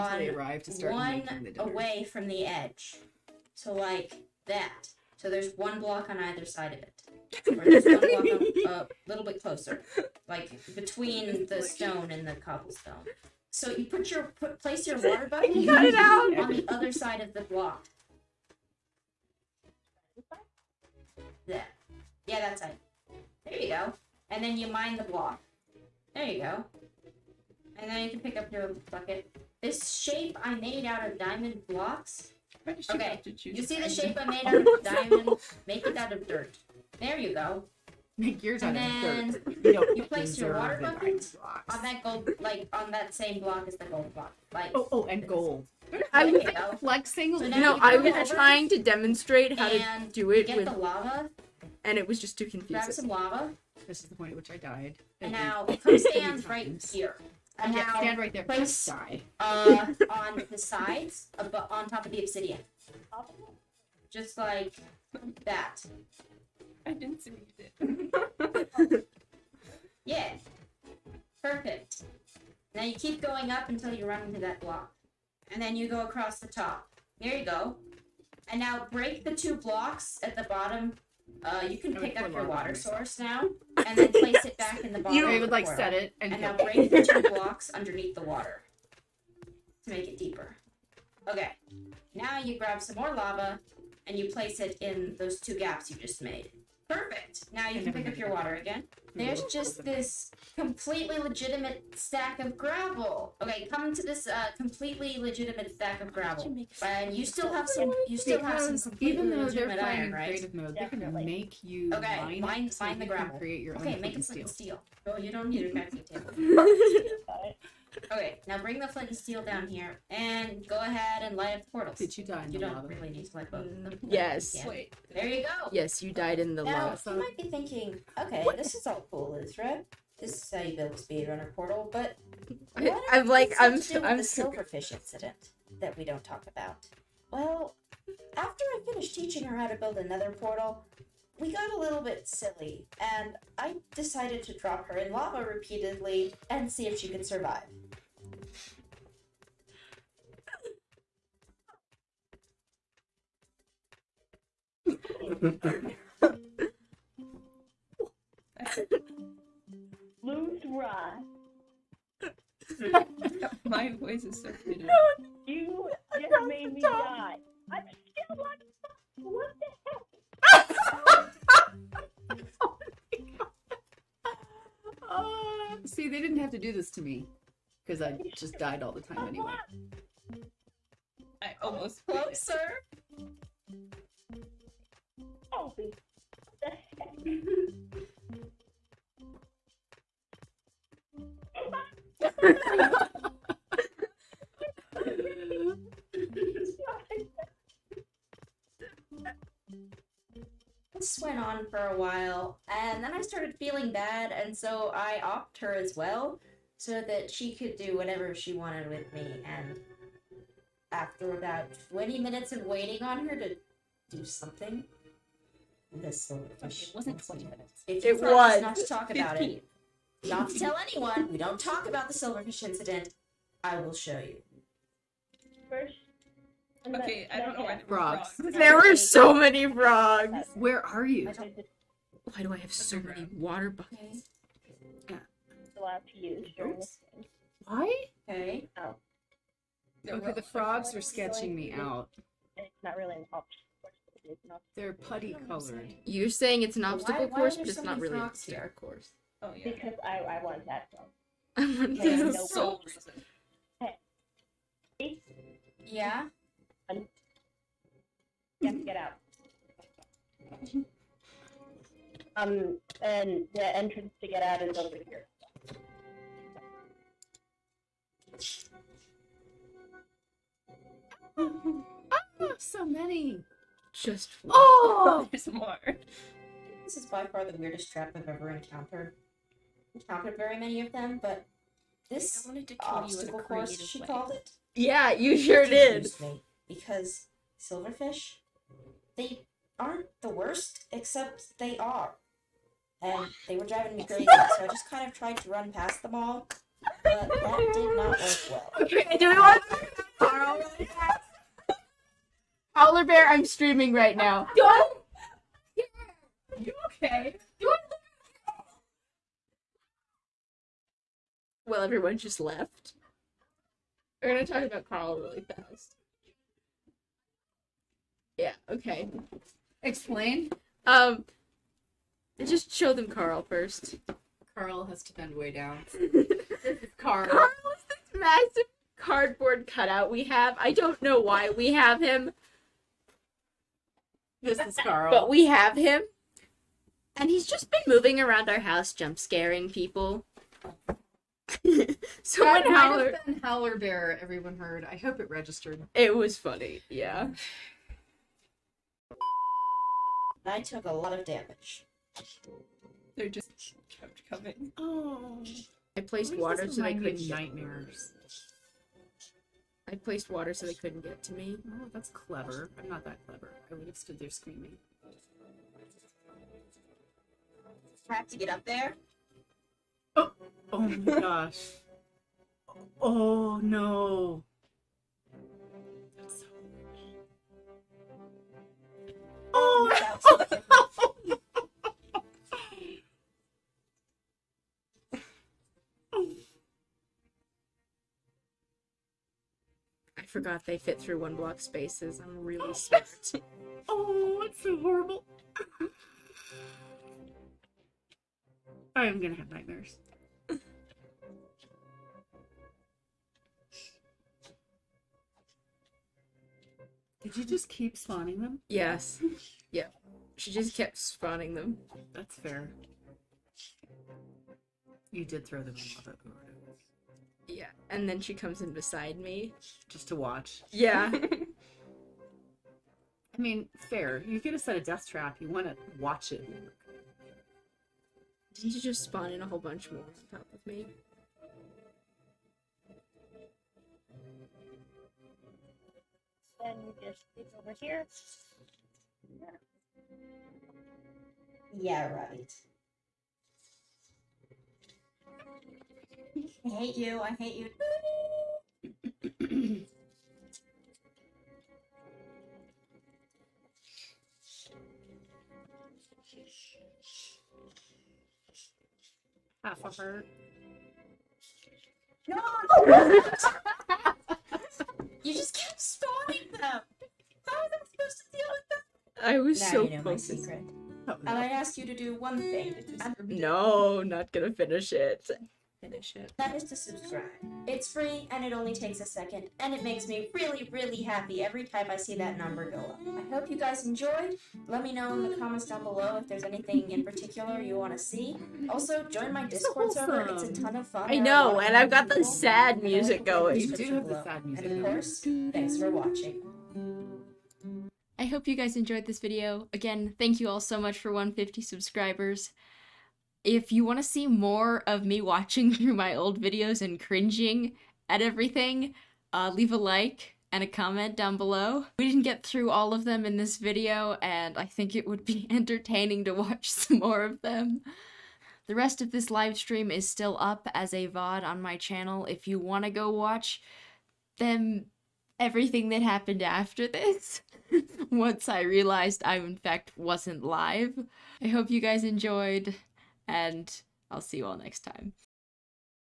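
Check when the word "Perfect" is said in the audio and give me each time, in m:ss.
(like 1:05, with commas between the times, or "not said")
1:11, 1:36.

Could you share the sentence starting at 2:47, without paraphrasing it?
I'm still on What the heck?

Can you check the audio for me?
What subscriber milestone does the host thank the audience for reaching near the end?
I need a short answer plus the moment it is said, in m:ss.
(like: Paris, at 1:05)
150, at 8:21.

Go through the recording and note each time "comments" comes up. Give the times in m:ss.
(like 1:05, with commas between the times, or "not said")
8:05, 8:30.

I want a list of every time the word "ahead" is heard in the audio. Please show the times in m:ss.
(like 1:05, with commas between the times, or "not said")
2:00.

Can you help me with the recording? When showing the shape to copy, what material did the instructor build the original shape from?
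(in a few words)
Diamond blocks.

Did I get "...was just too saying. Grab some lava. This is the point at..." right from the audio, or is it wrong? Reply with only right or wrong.
wrong.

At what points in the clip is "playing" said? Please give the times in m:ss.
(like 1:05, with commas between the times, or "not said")
1:49.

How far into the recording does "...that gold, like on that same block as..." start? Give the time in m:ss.
0:41.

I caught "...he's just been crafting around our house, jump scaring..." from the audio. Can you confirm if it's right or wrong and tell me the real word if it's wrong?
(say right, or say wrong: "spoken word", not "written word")
wrong: "moving", not "crafting".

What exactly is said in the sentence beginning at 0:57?
And yeah, now stand right there.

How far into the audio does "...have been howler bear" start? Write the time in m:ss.
5:43.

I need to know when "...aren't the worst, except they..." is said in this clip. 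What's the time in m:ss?
4:49.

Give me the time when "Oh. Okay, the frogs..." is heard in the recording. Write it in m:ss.
3:58.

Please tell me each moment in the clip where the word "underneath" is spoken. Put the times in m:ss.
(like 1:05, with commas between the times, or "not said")
1:27.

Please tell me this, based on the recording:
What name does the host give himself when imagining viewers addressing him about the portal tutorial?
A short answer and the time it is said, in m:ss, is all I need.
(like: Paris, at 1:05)
Ezra, at 2:09.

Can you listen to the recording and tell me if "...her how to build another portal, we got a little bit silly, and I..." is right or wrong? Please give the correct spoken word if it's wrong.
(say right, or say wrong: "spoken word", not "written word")
right.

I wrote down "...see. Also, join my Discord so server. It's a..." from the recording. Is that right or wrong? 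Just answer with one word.
right.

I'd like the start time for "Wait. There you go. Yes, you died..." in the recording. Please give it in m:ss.
2:04.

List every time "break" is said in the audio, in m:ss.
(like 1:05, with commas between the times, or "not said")
1:18, 1:26.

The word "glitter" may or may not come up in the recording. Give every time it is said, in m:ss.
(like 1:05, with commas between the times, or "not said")
not said.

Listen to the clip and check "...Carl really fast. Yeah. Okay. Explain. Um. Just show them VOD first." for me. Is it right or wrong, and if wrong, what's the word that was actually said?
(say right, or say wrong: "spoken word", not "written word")
wrong: "Carl", not "VOD".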